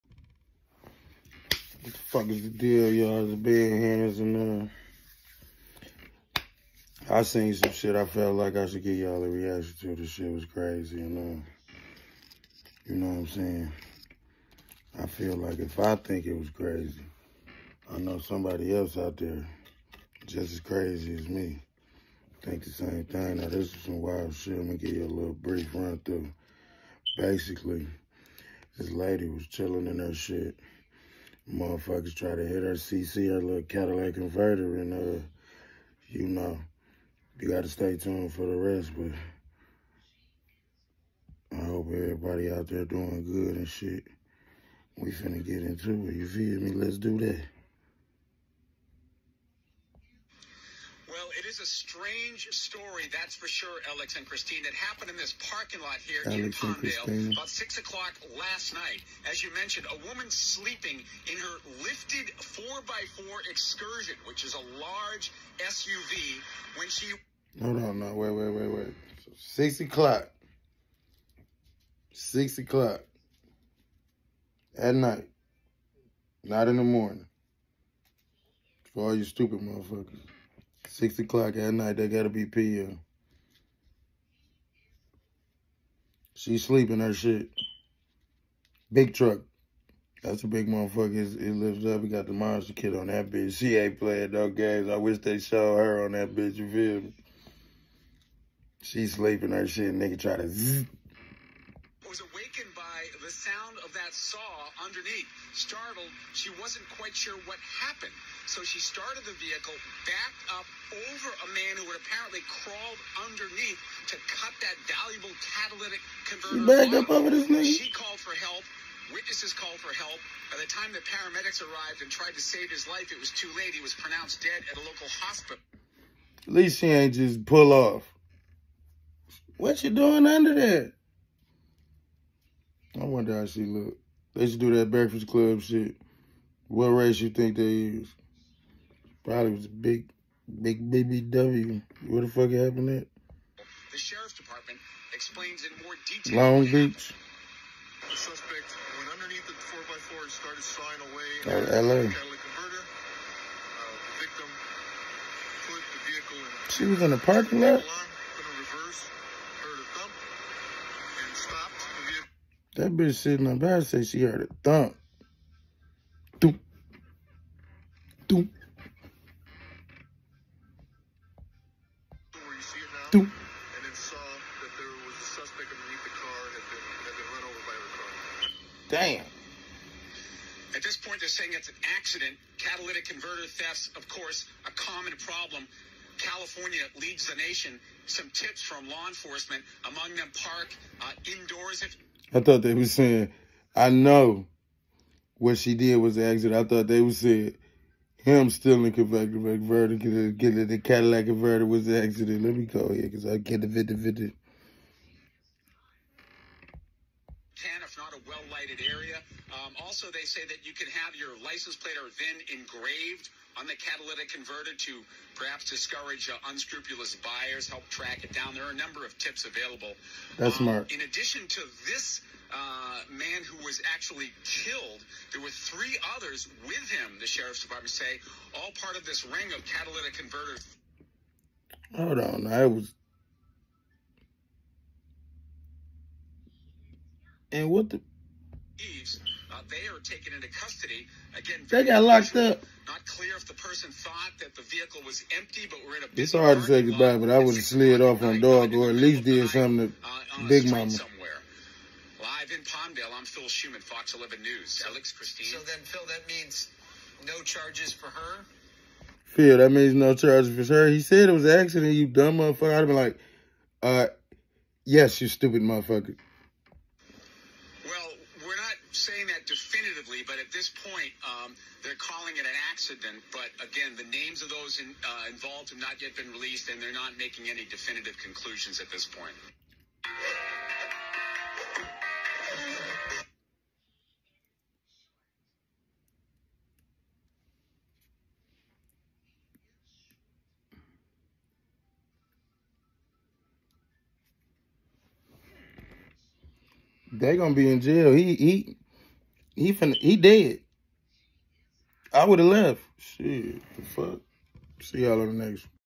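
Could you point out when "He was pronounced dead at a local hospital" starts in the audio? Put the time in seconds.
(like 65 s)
123 s.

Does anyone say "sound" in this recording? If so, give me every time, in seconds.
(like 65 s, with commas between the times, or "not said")
103 s.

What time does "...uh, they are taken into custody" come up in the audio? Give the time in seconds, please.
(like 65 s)
239 s.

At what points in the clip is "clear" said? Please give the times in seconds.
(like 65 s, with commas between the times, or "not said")
243 s.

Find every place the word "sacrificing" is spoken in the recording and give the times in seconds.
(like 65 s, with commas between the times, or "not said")
not said.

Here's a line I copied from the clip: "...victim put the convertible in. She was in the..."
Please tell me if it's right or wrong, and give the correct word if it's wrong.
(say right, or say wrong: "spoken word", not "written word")
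wrong: "vehicle", not "convertible".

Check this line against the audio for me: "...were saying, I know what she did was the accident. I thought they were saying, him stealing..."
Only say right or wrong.
right.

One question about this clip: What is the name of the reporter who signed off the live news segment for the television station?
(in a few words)
Phil Shuman.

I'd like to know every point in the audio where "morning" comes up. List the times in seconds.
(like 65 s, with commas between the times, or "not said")
76 s.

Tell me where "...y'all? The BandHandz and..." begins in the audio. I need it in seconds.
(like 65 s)
2 s.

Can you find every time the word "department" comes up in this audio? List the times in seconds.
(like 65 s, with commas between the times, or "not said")
144 s, 227 s.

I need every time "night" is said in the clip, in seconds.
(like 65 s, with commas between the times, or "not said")
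58 s, 74 s, 81 s.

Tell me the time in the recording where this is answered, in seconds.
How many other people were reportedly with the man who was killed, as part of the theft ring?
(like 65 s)
225 s.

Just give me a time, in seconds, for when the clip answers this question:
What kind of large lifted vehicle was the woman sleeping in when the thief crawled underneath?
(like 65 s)
62 s.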